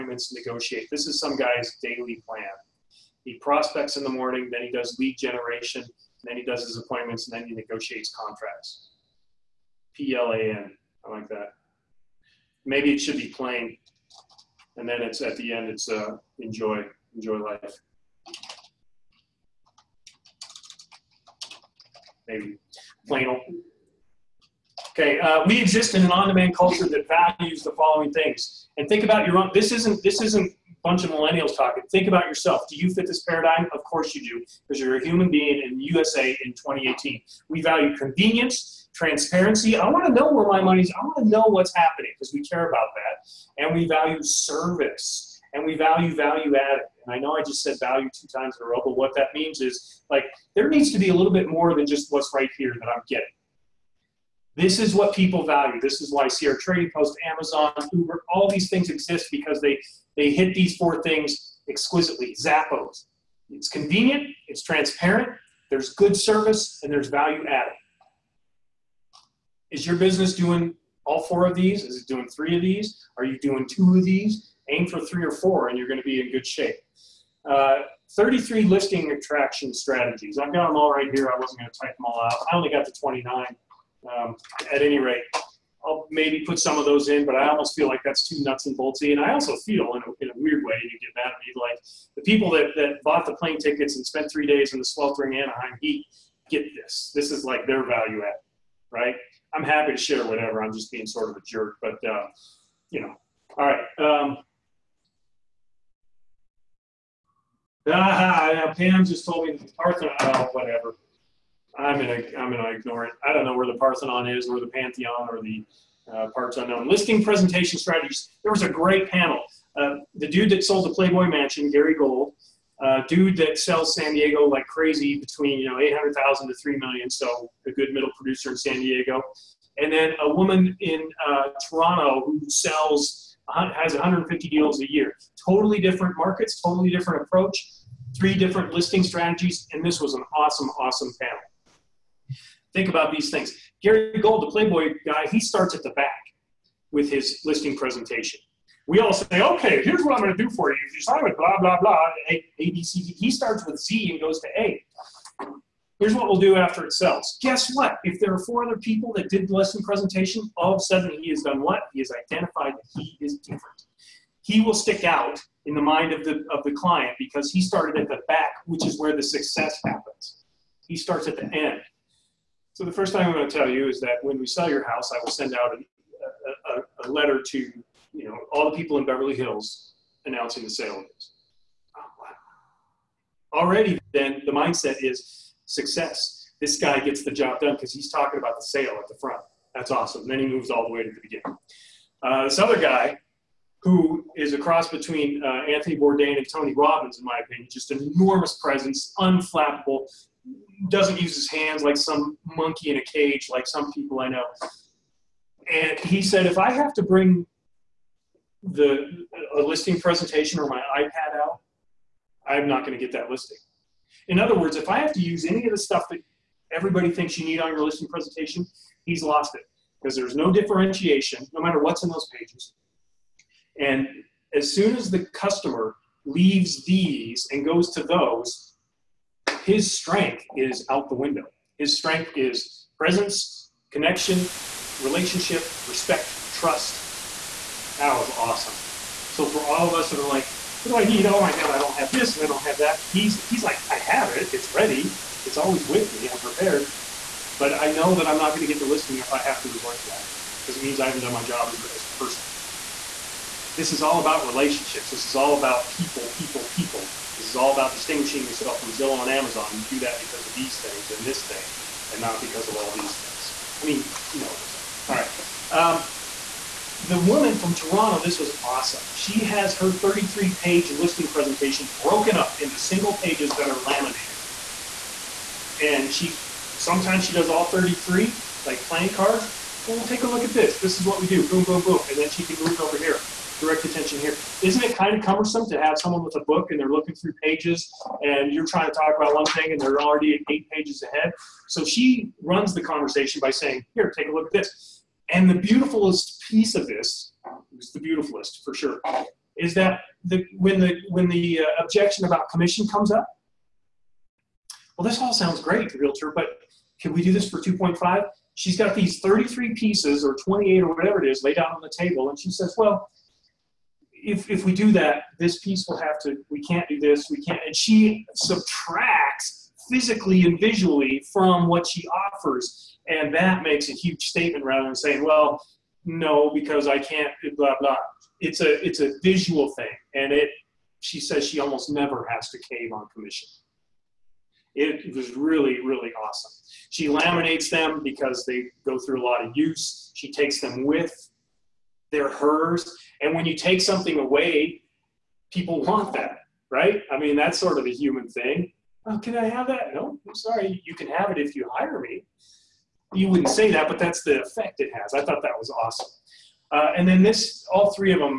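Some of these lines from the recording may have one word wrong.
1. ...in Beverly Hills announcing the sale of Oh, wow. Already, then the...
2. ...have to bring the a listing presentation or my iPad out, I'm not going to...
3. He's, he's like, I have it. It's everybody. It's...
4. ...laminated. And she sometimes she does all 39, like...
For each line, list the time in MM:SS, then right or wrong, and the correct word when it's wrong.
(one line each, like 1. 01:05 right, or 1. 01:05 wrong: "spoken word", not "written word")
1. 02:58 right
2. 03:26 right
3. 04:03 wrong: "ready", not "everybody"
4. 04:33 wrong: "33", not "39".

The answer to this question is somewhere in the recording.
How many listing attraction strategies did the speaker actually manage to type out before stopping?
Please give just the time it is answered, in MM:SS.
01:22.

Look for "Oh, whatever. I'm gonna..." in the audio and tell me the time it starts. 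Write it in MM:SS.
01:50.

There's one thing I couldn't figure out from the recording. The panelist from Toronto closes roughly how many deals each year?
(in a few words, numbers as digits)
150.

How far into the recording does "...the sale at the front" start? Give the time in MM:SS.
03:08.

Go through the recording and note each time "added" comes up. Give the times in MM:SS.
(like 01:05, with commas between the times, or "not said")
00:46, 01:07.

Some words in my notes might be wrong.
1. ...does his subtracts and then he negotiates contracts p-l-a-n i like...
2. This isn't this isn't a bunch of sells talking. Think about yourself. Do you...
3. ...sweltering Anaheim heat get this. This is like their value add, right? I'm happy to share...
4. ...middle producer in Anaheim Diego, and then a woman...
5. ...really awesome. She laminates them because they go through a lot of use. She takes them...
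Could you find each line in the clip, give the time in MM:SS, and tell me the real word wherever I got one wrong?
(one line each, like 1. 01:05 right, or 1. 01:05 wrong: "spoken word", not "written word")
1. 00:06 wrong: "appointments", not "subtracts"
2. 00:29 wrong: "millennials", not "sells"
3. 01:34 right
4. 02:07 wrong: "San", not "Anaheim"
5. 05:35 right.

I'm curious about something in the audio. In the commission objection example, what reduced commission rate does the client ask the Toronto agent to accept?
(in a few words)
2.5.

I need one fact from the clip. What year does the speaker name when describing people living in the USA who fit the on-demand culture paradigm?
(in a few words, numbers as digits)
2018.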